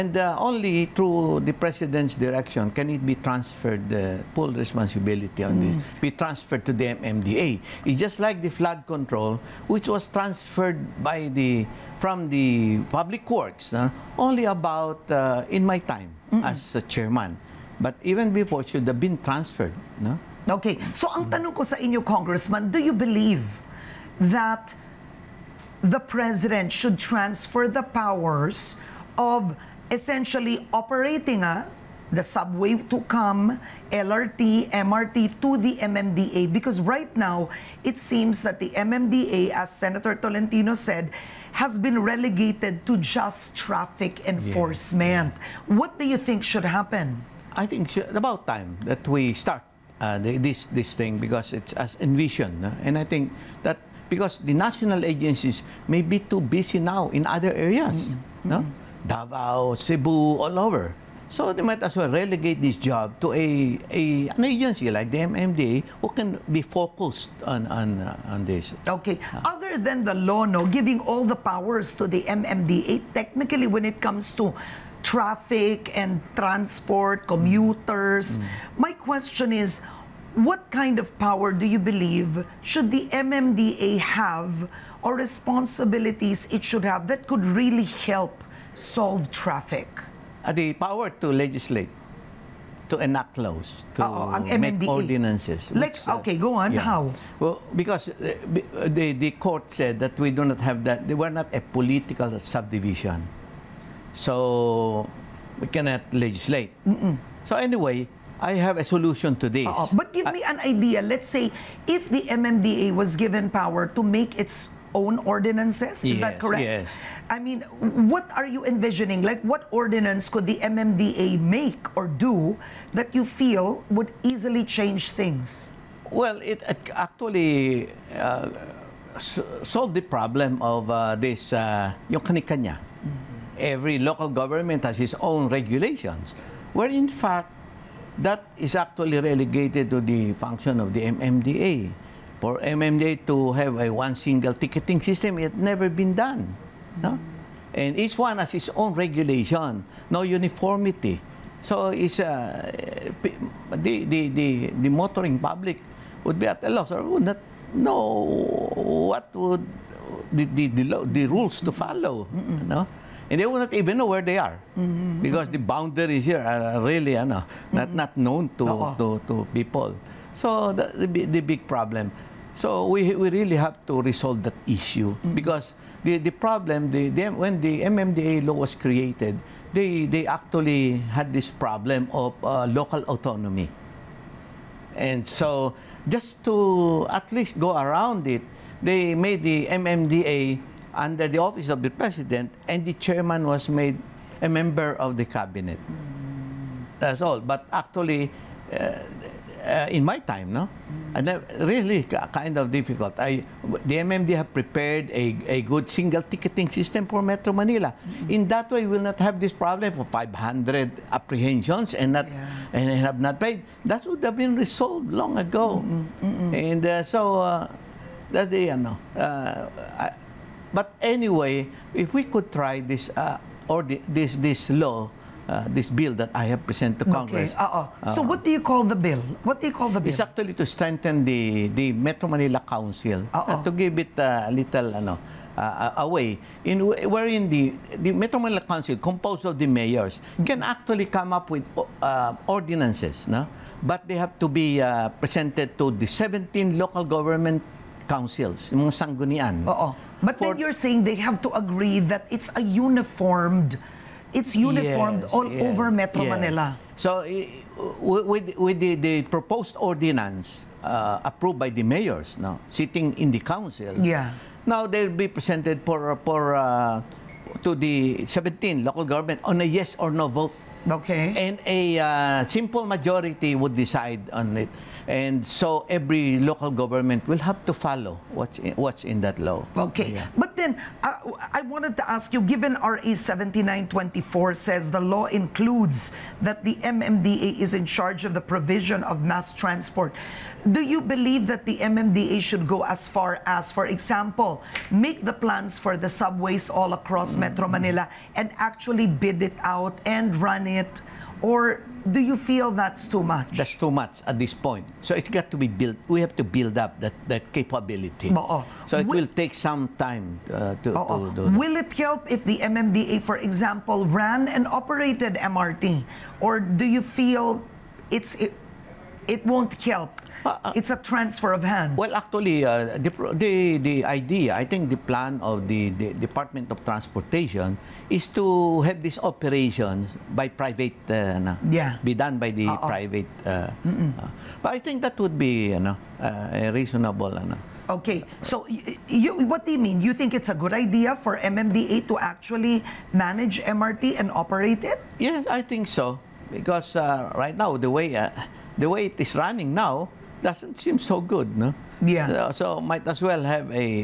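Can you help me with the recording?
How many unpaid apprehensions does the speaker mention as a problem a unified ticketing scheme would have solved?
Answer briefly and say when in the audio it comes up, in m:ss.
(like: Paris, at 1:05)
500, at 3:30.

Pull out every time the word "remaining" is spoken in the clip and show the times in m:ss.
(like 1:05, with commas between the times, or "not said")
not said.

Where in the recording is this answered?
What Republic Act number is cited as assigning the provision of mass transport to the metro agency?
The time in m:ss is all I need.
4:42.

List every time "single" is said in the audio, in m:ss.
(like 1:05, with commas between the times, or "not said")
2:24, 3:25.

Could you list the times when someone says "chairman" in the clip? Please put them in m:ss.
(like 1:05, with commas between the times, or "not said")
0:16, 3:12.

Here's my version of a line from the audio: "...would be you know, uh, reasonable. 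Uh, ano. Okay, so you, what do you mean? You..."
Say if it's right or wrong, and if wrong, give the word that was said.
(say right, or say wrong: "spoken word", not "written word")
right.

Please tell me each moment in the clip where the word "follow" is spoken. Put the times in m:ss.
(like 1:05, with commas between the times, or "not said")
2:41, 4:37.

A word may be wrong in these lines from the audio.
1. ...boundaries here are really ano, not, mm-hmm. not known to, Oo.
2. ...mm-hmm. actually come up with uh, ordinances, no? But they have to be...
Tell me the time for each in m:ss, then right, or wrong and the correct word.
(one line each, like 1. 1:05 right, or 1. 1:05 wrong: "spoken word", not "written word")
1. 2:45 right
2. 4:00 right.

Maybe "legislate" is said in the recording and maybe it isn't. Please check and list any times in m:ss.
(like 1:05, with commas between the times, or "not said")
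1:31, 1:46.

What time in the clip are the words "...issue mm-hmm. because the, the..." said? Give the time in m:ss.
2:54.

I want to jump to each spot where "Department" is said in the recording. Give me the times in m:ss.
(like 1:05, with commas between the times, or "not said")
5:26.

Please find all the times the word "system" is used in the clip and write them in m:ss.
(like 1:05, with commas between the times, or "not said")
2:24, 3:26.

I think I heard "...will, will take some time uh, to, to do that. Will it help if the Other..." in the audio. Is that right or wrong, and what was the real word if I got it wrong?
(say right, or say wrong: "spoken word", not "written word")
wrong: "MMDA", not "Other".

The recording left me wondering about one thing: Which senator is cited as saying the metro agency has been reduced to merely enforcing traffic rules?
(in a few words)
Senator Tolentino.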